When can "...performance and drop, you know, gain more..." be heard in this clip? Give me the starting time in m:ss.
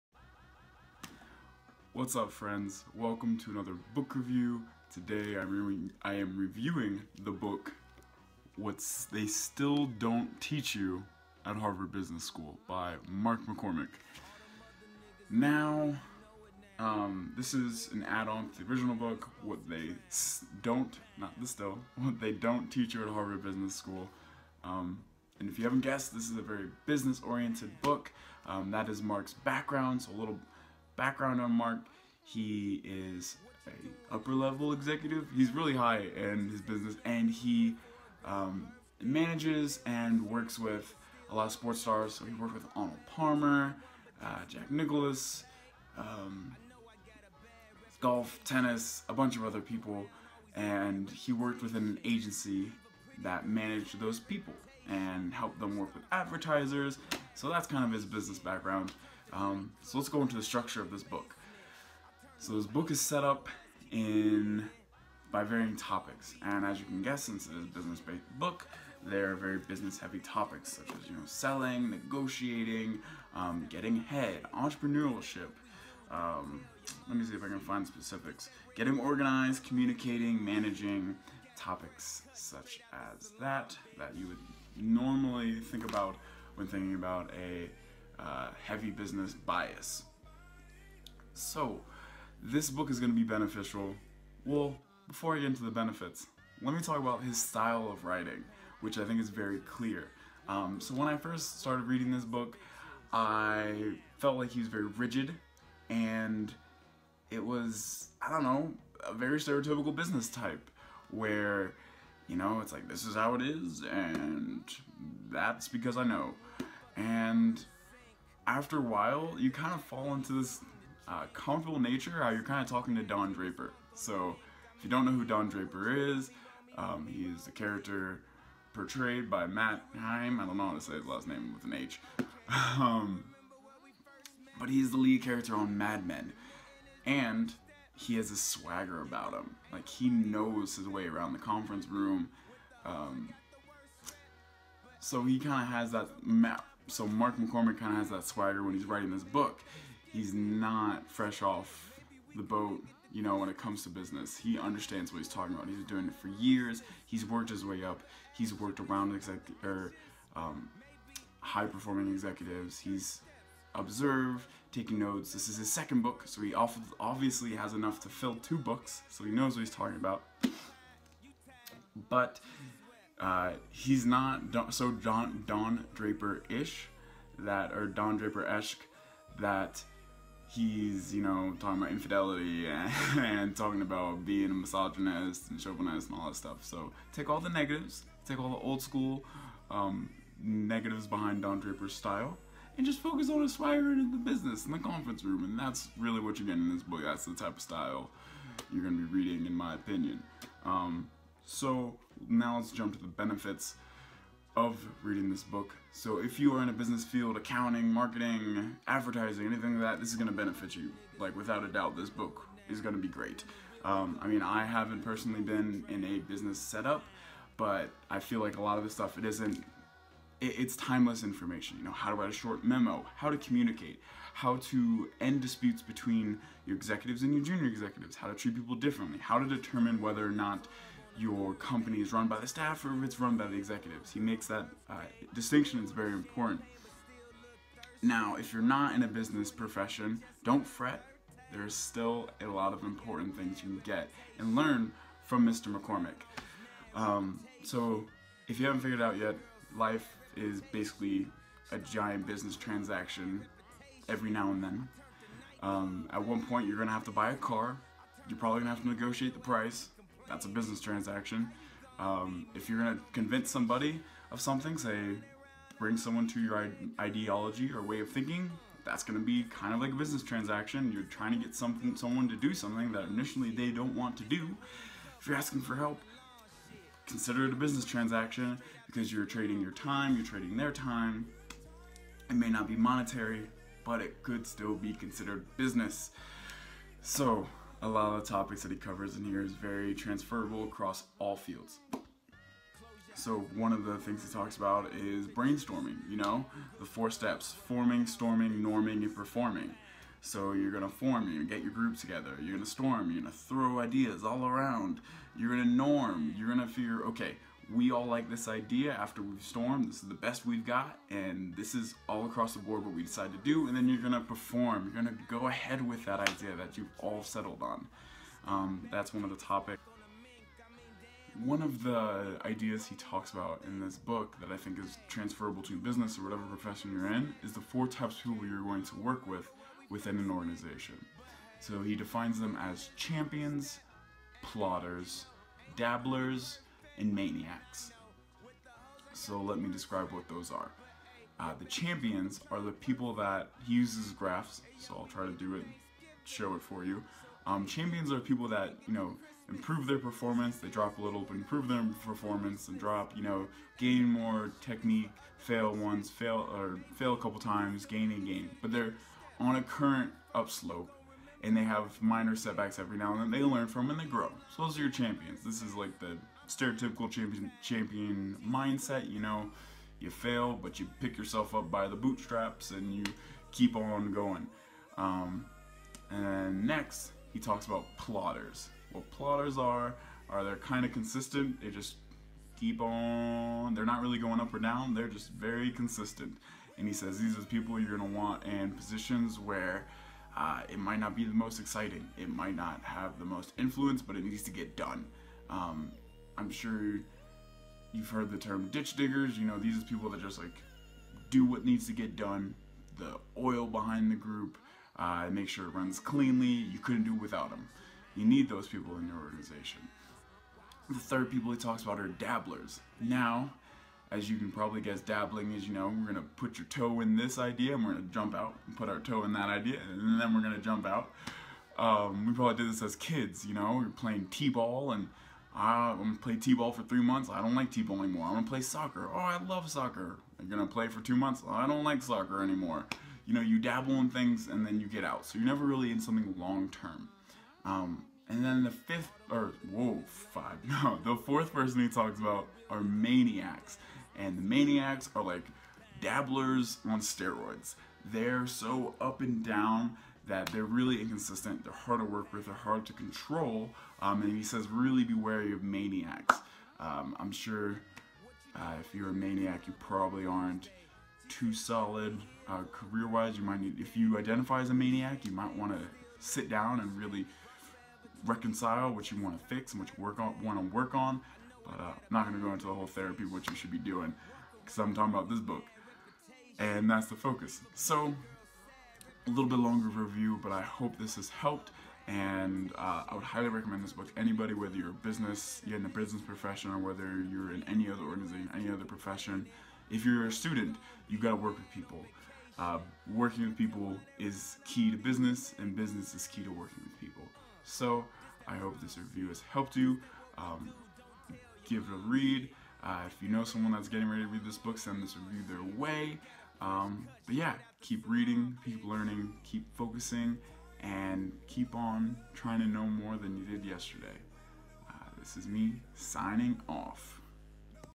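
5:52.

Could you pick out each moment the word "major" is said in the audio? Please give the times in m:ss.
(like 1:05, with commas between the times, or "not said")
not said.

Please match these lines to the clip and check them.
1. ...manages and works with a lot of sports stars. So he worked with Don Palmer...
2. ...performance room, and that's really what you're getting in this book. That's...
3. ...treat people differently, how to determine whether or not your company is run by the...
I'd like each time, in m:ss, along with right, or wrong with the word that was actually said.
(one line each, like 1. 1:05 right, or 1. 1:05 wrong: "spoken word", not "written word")
1. 0:39 wrong: "Arnold", not "Don"
2. 3:14 wrong: "conference", not "performance"
3. 3:48 right.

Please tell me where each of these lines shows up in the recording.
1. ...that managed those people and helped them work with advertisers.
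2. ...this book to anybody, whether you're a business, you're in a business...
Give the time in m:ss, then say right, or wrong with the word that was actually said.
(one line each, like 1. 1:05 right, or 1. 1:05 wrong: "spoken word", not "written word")
1. 0:53 right
2. 8:03 right.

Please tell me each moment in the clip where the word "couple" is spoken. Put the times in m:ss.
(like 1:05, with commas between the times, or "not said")
5:57.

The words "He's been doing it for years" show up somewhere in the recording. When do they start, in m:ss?
2:35.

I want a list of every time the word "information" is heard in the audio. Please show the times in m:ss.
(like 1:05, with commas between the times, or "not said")
3:41.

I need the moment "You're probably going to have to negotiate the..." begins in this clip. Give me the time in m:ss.
4:18.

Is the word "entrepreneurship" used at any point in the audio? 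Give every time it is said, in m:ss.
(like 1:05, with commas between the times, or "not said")
1:14.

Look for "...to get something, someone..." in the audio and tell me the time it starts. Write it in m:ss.
4:31.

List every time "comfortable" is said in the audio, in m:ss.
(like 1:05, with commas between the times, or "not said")
2:01.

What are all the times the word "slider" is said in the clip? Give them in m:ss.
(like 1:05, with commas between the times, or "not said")
not said.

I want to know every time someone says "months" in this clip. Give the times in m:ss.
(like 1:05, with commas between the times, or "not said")
7:07, 7:11.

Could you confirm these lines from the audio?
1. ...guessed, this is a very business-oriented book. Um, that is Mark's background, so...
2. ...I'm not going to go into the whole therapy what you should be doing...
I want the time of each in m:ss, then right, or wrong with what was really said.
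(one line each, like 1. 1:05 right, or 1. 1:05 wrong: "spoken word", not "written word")
1. 0:25 right
2. 7:51 right.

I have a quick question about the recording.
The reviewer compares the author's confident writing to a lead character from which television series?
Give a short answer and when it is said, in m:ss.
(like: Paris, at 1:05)
Mad Men, at 2:15.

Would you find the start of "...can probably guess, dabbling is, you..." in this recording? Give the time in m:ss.
6:54.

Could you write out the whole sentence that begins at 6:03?
They learn from and they grow.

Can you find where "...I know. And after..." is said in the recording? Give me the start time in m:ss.
1:55.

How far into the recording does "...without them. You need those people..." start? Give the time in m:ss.
6:47.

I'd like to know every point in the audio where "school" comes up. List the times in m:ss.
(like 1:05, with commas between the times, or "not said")
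0:12, 0:23, 3:08.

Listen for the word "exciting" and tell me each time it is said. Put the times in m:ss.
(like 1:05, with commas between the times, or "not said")
6:31.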